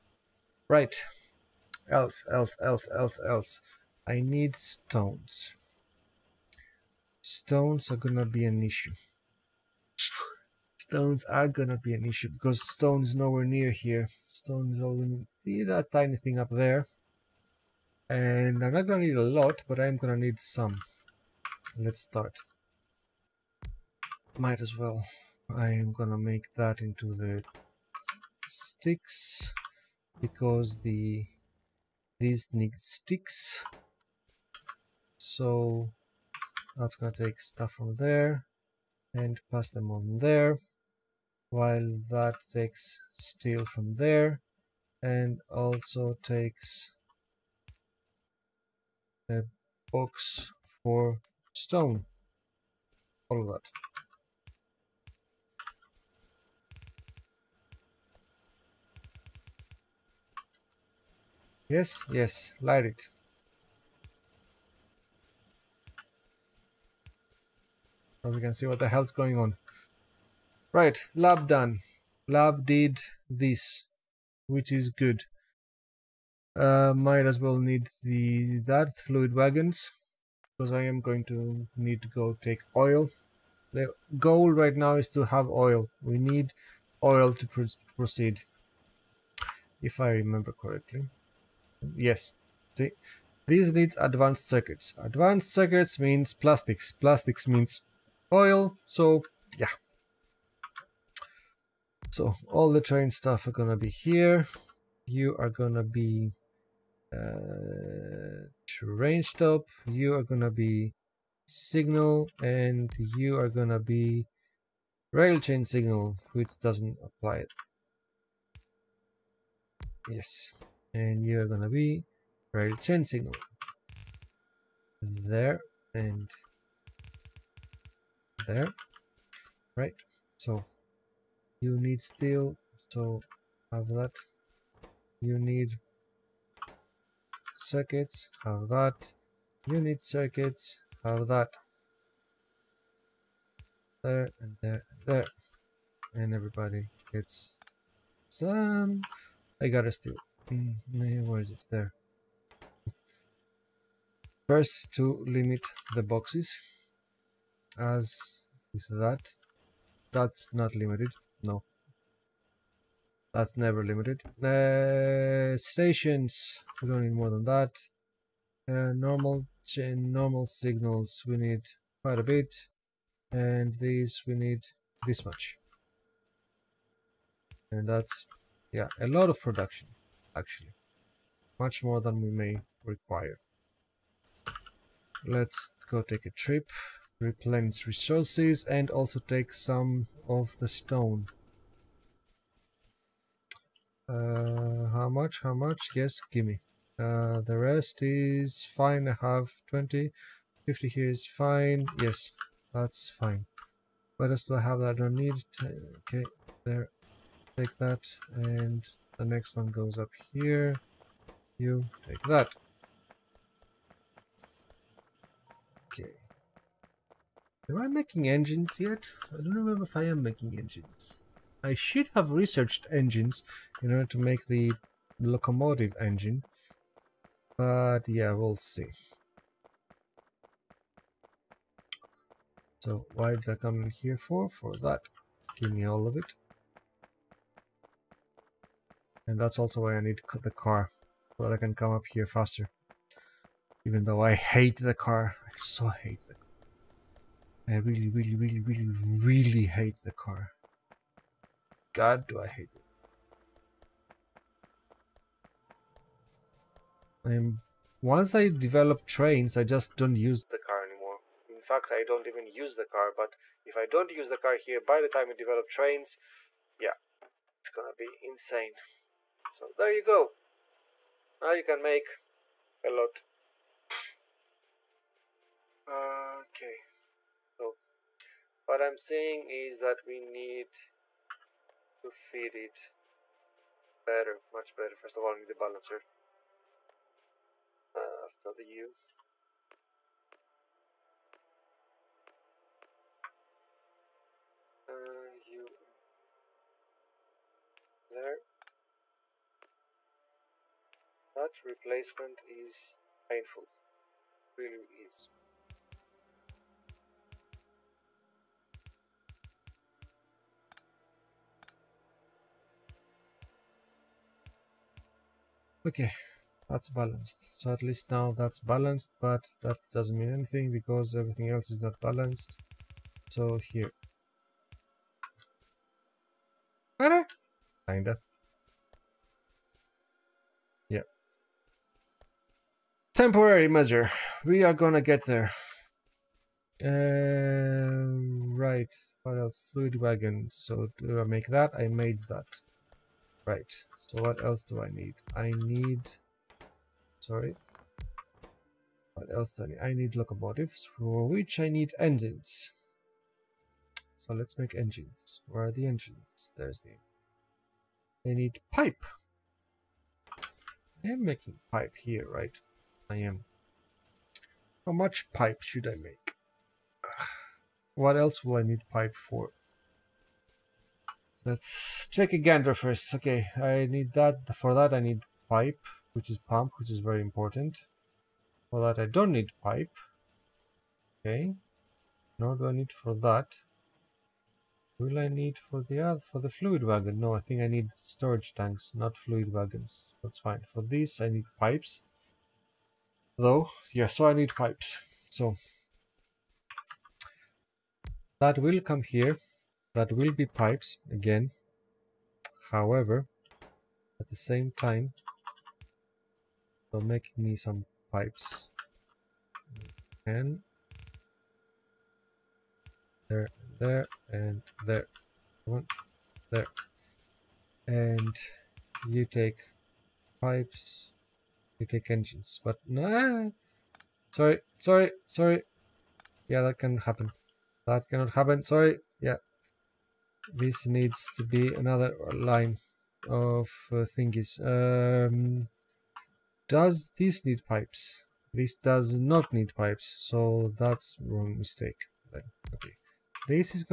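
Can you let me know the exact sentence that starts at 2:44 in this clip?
Uh, stations, we don't need more than that.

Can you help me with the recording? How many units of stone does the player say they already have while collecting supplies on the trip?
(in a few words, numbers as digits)
20.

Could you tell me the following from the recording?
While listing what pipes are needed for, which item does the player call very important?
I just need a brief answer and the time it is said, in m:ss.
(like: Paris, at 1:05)
Pump, at 6:16.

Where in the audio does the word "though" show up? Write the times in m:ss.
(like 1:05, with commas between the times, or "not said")
4:04, 6:33.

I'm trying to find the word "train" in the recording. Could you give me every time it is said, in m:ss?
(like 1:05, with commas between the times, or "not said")
1:42, 1:48, 4:19, 4:25.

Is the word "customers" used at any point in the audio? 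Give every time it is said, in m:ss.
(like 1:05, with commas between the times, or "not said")
not said.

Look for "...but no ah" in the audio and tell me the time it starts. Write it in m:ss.
7:02.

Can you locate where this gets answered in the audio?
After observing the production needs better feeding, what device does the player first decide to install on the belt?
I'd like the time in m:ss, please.
4:45.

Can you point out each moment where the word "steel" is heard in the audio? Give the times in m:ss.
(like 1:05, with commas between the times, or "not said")
0:43, 2:12.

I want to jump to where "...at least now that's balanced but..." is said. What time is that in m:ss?
5:17.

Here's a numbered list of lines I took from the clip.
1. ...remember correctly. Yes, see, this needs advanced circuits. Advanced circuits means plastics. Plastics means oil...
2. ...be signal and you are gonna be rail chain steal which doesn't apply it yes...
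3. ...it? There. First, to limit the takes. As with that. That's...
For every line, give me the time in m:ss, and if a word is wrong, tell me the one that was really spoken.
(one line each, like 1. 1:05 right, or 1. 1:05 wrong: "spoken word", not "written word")
1. 1:30 right
2. 1:50 wrong: "signal", not "steal"
3. 2:31 wrong: "boxes", not "takes".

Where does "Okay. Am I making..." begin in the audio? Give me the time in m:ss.
3:35.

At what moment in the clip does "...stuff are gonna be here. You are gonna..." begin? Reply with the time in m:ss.
1:43.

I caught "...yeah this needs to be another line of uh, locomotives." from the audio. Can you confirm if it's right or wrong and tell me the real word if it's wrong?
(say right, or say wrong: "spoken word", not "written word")
wrong: "thingies", not "locomotives".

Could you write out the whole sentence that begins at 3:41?
I should have researched engines in order to make the locomotive engine.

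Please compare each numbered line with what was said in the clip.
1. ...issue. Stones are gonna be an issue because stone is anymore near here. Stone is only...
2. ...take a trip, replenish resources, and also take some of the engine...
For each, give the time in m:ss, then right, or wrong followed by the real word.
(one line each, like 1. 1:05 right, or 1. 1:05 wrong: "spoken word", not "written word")
1. 0:08 wrong: "nowhere", not "anymore"
2. 3:06 wrong: "stone", not "engine".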